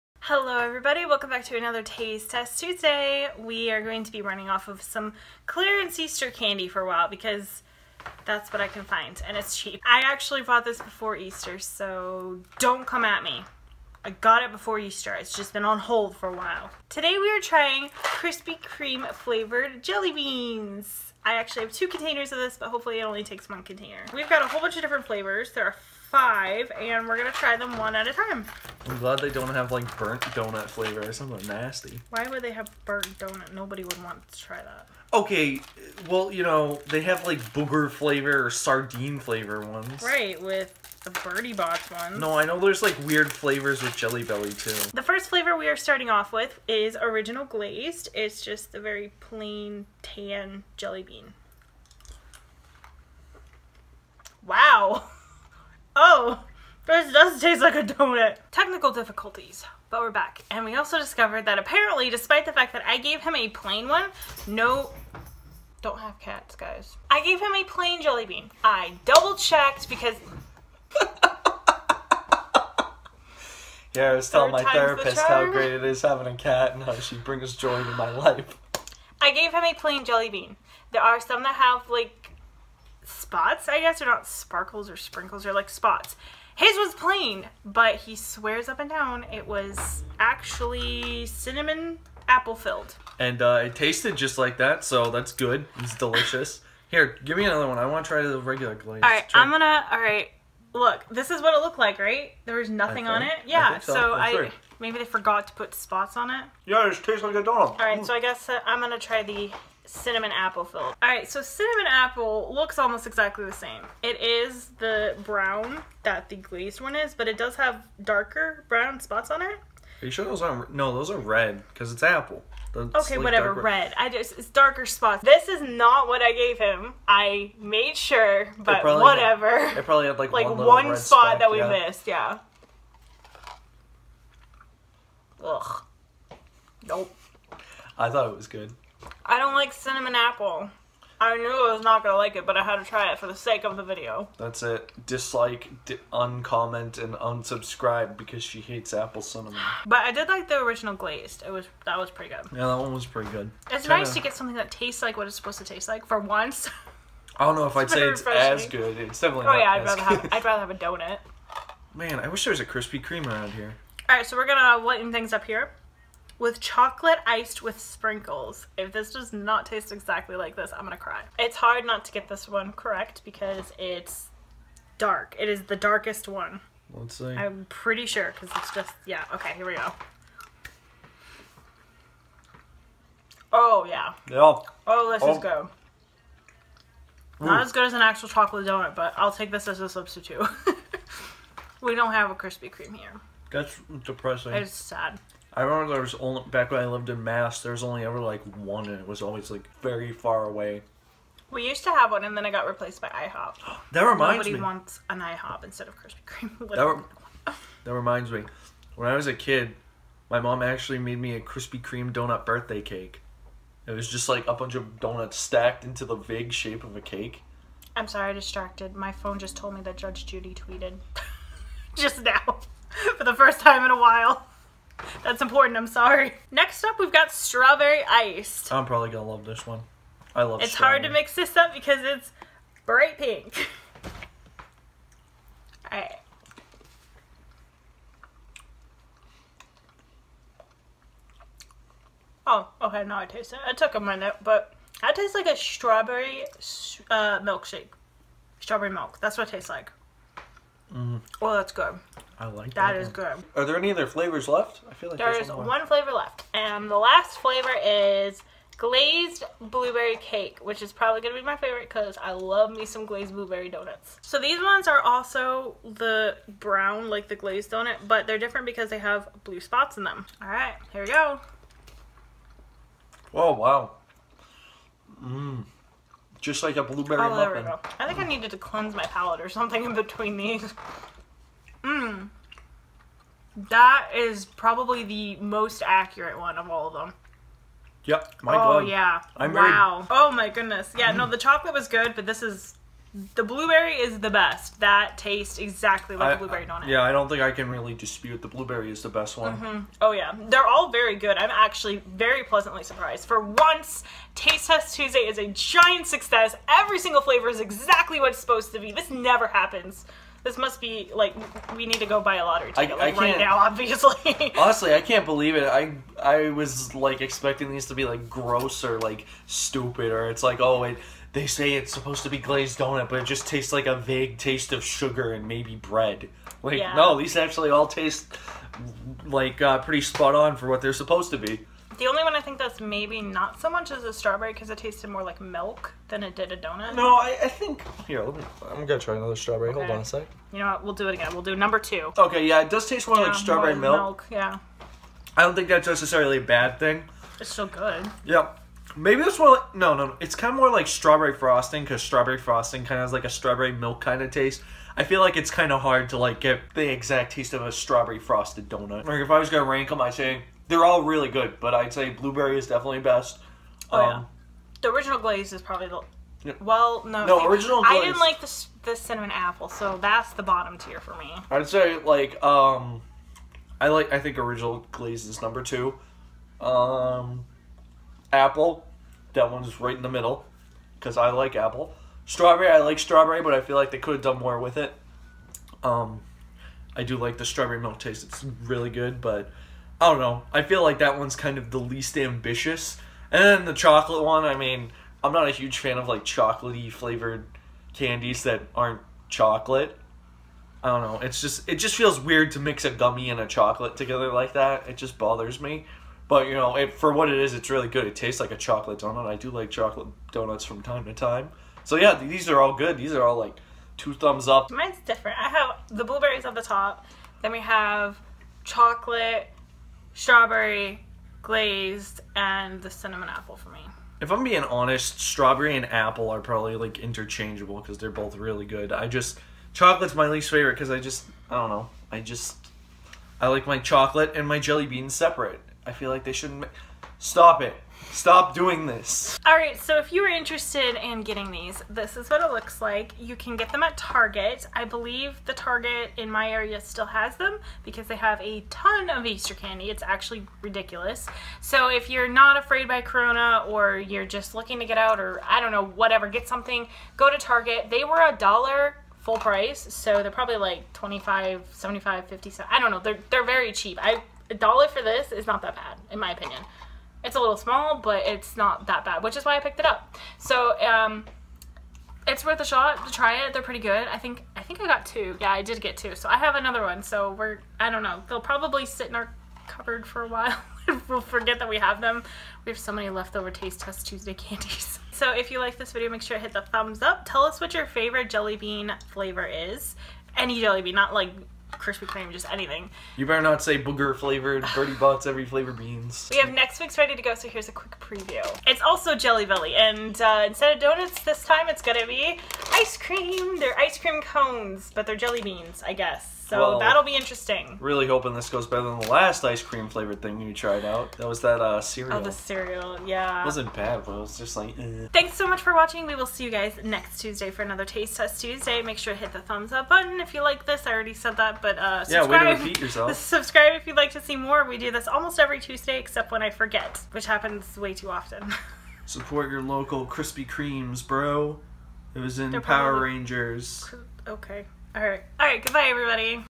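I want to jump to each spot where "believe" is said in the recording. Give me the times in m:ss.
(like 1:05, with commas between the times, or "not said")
5:15, 7:24.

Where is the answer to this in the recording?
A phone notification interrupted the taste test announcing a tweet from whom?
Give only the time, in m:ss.
3:39.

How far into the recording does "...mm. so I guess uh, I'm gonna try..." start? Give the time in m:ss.
1:48.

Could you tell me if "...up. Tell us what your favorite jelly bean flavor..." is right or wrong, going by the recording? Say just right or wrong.
right.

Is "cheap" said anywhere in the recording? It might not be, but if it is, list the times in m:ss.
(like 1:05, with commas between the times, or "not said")
0:09, 7:43.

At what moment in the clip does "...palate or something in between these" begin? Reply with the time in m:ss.
4:39.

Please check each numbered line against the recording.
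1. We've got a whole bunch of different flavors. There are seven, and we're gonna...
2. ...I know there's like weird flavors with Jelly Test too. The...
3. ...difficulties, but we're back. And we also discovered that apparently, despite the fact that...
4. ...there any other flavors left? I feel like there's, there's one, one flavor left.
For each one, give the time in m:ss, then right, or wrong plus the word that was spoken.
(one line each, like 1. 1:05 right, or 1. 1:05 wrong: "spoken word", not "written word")
1. 0:24 wrong: "five", not "seven"
2. 0:42 wrong: "Belly", not "Test"
3. 0:58 right
4. 4:13 right.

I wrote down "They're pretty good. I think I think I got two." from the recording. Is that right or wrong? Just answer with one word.
right.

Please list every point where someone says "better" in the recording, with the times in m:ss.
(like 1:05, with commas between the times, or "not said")
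8:13, 8:28.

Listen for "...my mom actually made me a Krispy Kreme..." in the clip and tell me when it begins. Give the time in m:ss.
3:30.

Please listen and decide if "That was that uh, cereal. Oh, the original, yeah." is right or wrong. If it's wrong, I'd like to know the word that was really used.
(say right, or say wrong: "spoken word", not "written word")
wrong: "cereal", not "original".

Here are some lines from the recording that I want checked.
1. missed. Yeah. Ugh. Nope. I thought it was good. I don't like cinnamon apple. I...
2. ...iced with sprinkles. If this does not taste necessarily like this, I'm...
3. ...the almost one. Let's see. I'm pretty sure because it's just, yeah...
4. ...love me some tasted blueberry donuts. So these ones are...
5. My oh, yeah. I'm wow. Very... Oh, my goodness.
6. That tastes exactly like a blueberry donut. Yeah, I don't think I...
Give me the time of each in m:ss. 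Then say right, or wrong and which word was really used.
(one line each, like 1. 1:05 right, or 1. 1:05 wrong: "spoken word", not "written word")
1. 2:11 right
2. 2:47 wrong: "exactly", not "necessarily"
3. 2:55 wrong: "darkest", not "almost"
4. 4:22 wrong: "glazed", not "tasted"
5. 4:48 right
6. 4:54 right.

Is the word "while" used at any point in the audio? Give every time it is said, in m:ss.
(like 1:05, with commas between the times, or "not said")
0:06, 0:16, 3:43, 8:00.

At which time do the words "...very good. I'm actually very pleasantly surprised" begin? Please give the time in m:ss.
5:00.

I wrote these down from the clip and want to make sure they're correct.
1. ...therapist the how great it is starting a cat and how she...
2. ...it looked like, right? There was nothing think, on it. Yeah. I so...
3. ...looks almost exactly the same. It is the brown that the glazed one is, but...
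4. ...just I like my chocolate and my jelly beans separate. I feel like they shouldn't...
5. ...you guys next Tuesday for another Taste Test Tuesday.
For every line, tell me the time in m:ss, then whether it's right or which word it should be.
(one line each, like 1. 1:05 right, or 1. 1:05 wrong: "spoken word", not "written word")
1. 1:14 wrong: "having", not "starting"
2. 1:41 right
3. 1:52 right
4. 7:12 right
5. 8:36 right.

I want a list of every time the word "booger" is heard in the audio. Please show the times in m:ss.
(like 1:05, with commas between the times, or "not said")
0:37, 8:13.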